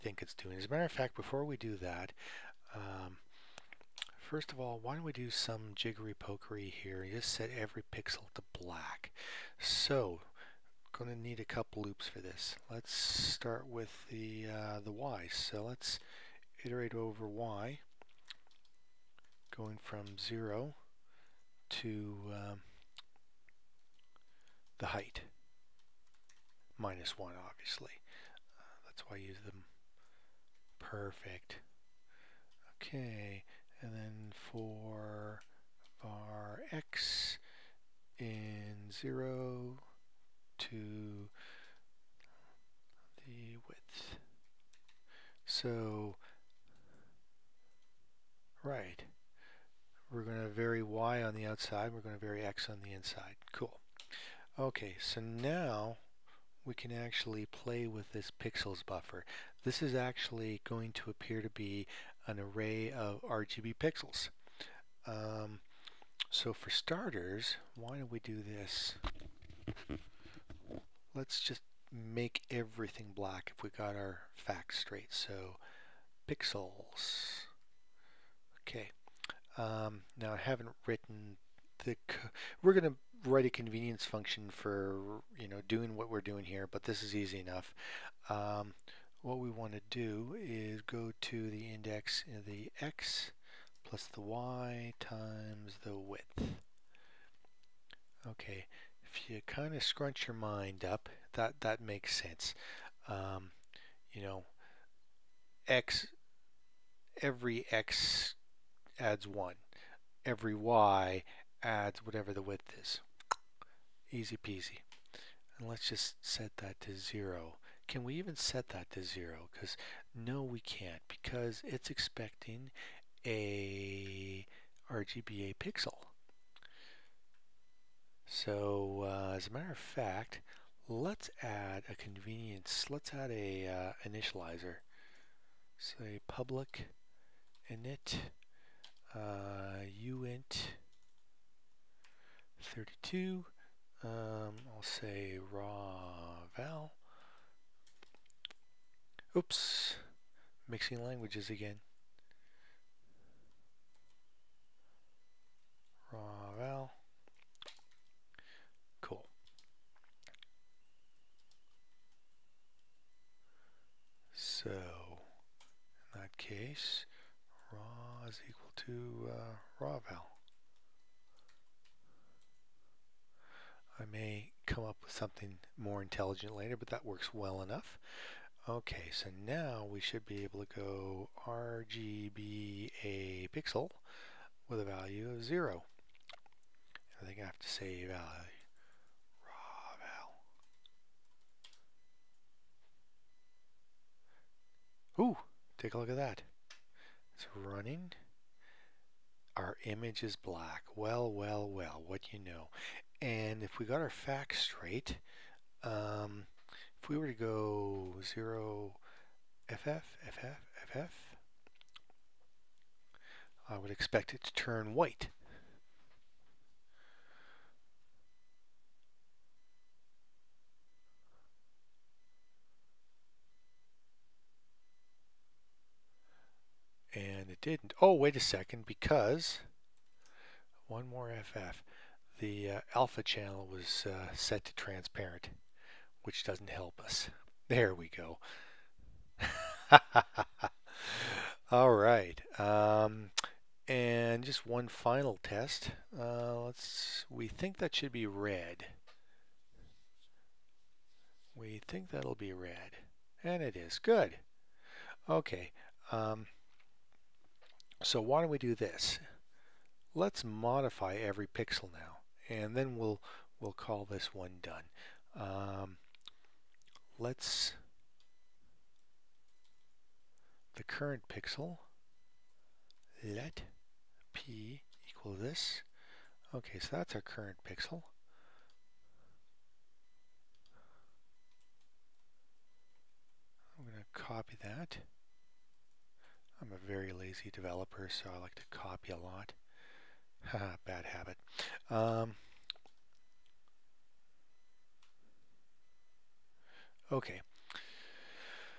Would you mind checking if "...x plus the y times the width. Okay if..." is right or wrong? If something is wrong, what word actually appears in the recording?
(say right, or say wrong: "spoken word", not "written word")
right.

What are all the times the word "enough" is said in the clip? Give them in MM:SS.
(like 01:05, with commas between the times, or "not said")
01:27, 02:57.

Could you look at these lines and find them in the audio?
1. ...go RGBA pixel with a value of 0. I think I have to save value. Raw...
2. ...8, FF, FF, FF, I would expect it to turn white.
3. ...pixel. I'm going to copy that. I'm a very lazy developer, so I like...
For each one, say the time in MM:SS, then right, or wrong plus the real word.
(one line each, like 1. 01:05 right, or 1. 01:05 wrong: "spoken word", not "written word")
1. 03:00 right
2. 03:28 wrong: "0", not "8"
3. 04:37 right.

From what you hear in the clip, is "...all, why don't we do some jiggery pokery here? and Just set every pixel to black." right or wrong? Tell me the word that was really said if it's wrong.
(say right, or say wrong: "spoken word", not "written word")
right.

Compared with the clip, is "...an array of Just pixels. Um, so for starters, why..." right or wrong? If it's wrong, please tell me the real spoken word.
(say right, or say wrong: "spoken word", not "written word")
wrong: "RGB", not "Just".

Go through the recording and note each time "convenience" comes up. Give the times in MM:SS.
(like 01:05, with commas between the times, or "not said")
01:23, 02:11.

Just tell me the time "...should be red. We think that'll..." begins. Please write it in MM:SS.
04:07.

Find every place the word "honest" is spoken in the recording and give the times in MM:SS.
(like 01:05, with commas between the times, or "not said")
not said.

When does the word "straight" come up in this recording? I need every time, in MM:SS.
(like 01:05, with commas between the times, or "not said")
01:14, 03:24.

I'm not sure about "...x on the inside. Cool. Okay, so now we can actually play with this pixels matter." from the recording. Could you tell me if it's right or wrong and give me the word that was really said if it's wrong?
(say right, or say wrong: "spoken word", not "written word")
wrong: "buffer", not "matter".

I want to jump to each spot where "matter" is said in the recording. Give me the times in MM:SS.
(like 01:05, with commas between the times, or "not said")
00:00, 02:09.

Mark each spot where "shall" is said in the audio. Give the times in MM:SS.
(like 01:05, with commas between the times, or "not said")
not said.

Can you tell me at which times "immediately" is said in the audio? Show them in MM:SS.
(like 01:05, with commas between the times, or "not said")
not said.